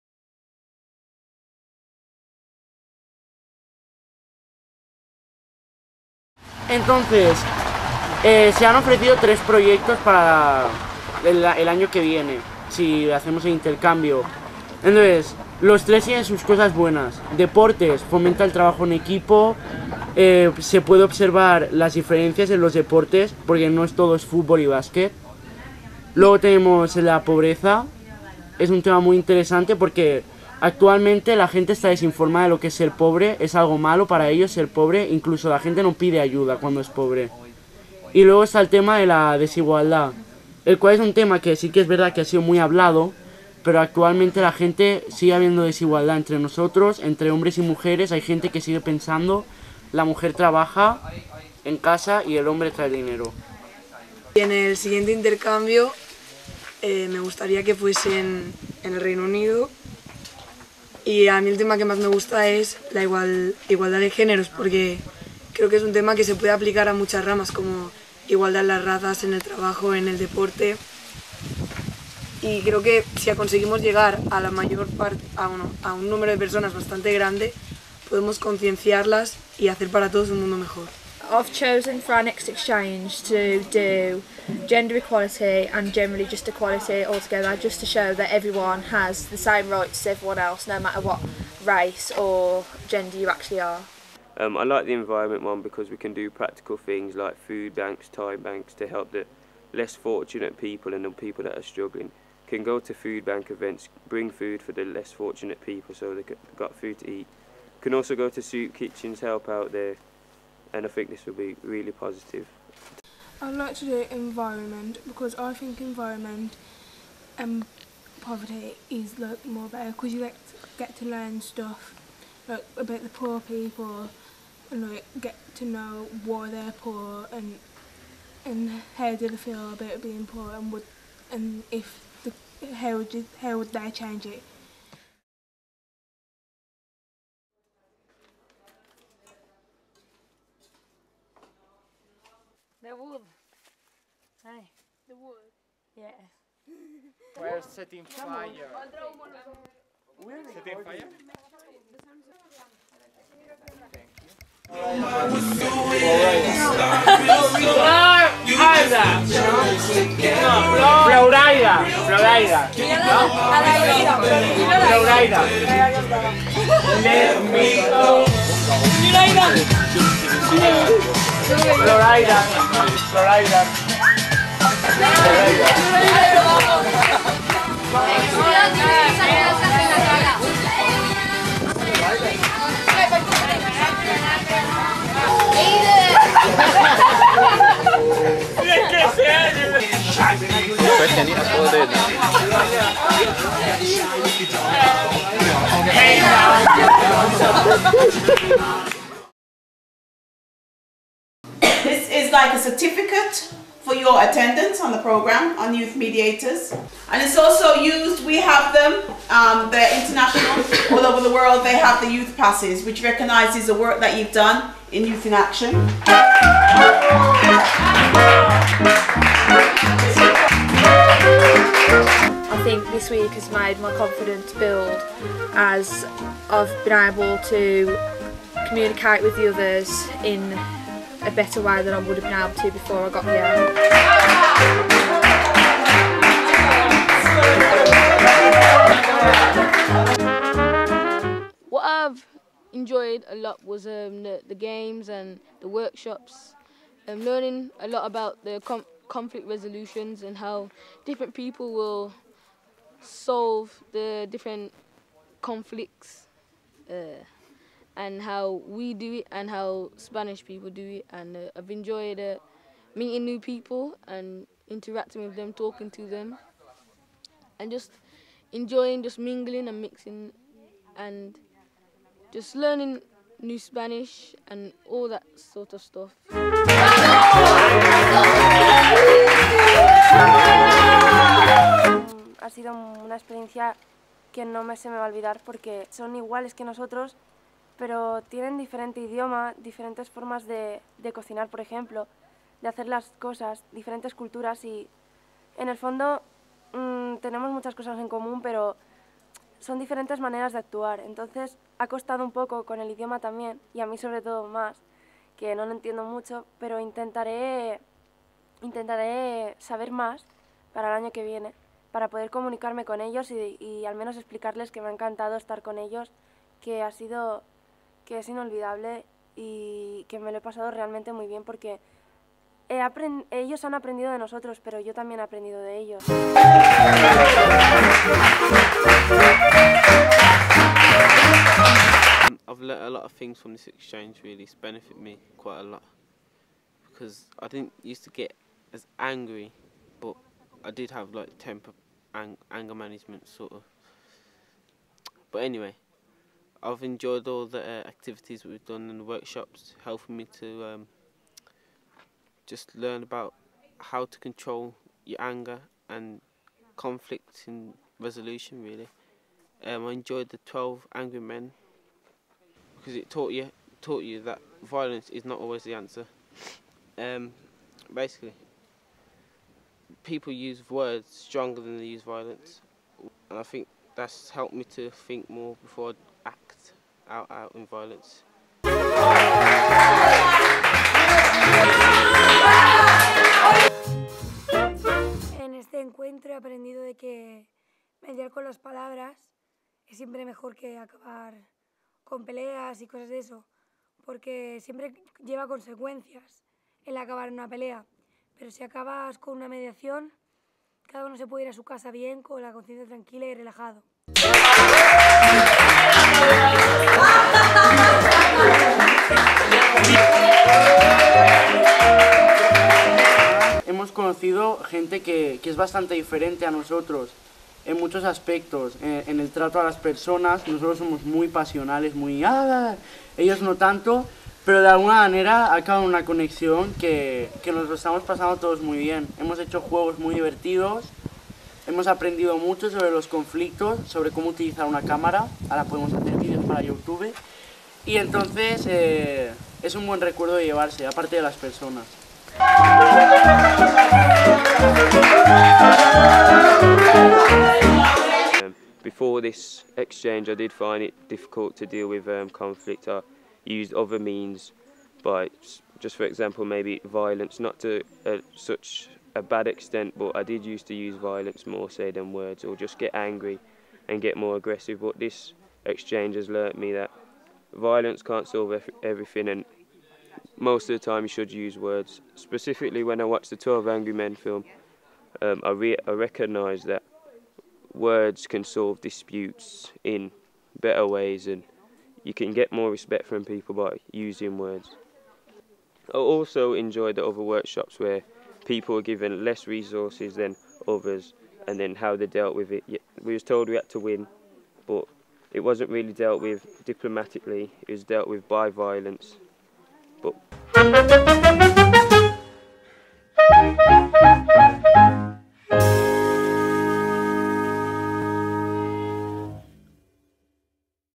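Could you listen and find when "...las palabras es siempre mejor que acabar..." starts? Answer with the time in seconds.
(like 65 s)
388 s.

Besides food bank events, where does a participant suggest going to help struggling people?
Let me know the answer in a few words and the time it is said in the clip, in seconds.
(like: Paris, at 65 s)
soup kitchens, at 108 s.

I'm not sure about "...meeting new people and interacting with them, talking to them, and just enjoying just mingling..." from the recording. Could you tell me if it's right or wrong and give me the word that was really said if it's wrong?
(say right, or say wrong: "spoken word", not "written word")
right.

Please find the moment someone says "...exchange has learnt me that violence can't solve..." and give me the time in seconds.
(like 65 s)
465 s.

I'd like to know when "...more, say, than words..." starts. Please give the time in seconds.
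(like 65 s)
461 s.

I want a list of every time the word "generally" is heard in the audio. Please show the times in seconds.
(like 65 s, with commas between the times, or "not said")
85 s.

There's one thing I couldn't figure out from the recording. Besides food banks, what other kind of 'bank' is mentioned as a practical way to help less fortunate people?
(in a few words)
time banks.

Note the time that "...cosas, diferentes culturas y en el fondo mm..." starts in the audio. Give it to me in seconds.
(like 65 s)
293 s.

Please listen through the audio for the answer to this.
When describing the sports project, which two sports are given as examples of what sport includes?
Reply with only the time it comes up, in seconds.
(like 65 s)
24 s.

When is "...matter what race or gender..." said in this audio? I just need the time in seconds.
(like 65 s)
90 s.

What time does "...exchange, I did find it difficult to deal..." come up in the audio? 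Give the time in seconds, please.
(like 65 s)
449 s.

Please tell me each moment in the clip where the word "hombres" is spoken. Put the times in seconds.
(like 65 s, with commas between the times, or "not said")
47 s, 52 s.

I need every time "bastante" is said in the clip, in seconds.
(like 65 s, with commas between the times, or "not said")
76 s, 415 s.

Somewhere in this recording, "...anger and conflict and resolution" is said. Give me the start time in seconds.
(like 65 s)
355 s.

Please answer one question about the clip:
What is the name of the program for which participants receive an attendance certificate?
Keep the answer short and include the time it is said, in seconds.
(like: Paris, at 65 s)
Youth Mediators, at 205 s.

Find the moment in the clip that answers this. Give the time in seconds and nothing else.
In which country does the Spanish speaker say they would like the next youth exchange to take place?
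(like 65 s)
58 s.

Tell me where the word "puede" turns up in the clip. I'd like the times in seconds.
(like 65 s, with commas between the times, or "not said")
20 s, 66 s, 401 s.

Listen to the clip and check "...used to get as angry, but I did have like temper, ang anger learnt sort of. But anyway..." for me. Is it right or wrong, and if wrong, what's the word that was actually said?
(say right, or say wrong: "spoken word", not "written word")
wrong: "management", not "learnt".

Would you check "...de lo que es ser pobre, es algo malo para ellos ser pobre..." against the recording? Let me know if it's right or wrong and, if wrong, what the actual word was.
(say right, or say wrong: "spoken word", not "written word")
right.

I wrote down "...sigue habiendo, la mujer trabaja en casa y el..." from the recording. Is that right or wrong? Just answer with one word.
wrong.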